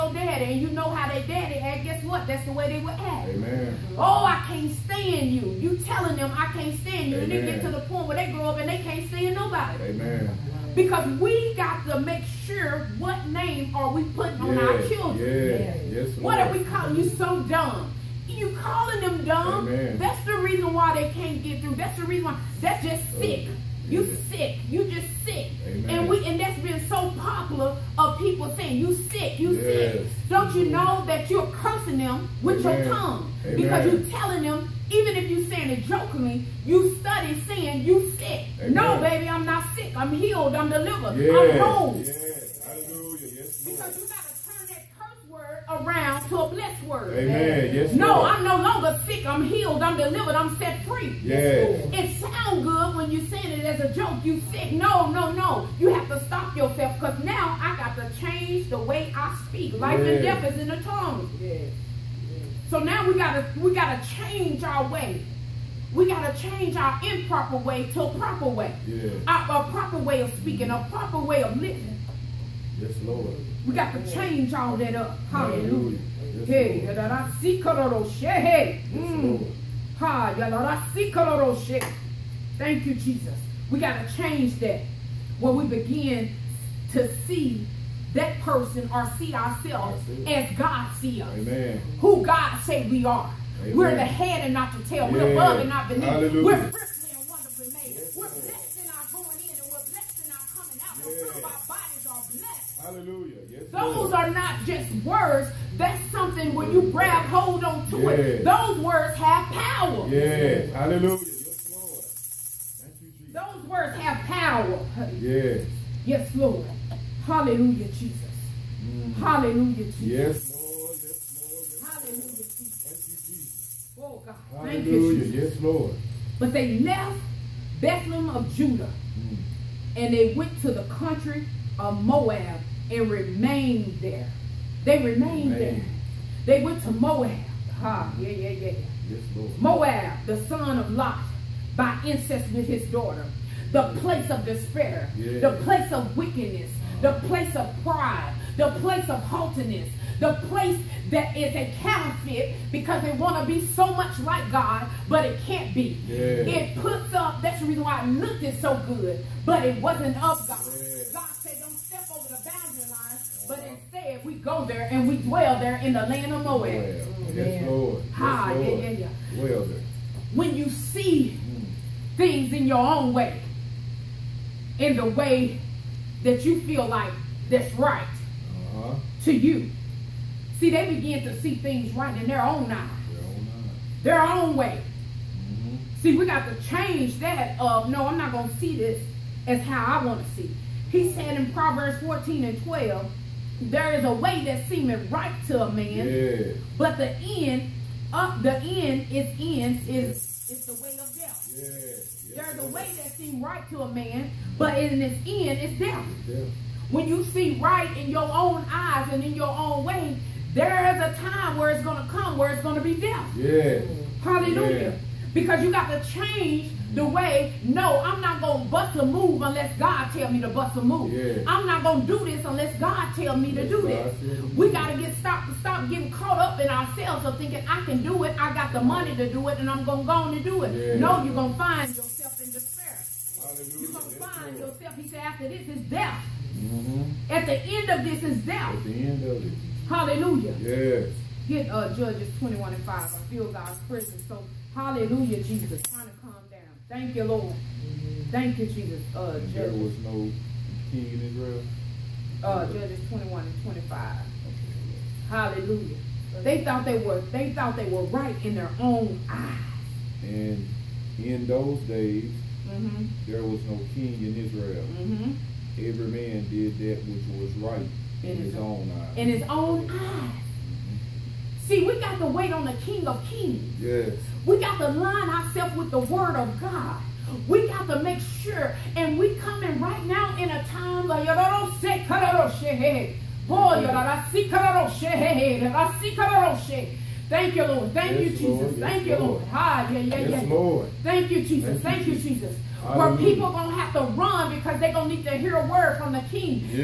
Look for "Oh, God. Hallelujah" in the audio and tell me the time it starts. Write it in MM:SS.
02:04.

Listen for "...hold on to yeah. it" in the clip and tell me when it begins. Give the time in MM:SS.
01:47.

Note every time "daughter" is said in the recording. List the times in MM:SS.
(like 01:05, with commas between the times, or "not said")
02:22.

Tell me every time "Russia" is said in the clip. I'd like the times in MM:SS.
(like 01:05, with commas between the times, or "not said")
not said.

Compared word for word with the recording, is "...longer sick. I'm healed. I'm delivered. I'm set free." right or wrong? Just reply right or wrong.
right.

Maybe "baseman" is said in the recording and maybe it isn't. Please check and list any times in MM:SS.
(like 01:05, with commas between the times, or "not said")
not said.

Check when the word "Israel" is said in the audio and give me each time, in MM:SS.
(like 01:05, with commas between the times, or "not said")
04:11, 04:24.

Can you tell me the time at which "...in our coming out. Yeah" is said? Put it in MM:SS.
01:40.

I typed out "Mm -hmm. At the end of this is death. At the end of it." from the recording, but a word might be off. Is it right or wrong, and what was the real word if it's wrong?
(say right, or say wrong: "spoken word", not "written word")
right.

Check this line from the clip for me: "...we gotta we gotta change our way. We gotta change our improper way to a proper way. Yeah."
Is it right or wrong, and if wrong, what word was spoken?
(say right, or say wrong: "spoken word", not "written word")
right.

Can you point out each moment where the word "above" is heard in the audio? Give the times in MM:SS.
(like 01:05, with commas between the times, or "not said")
01:35.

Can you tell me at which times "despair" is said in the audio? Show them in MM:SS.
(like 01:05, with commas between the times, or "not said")
02:24, 03:52.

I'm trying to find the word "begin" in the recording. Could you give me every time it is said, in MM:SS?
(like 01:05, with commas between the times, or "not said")
01:25, 03:00.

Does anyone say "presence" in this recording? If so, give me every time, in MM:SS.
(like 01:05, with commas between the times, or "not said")
04:03.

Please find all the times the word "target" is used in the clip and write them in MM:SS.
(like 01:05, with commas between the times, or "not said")
not said.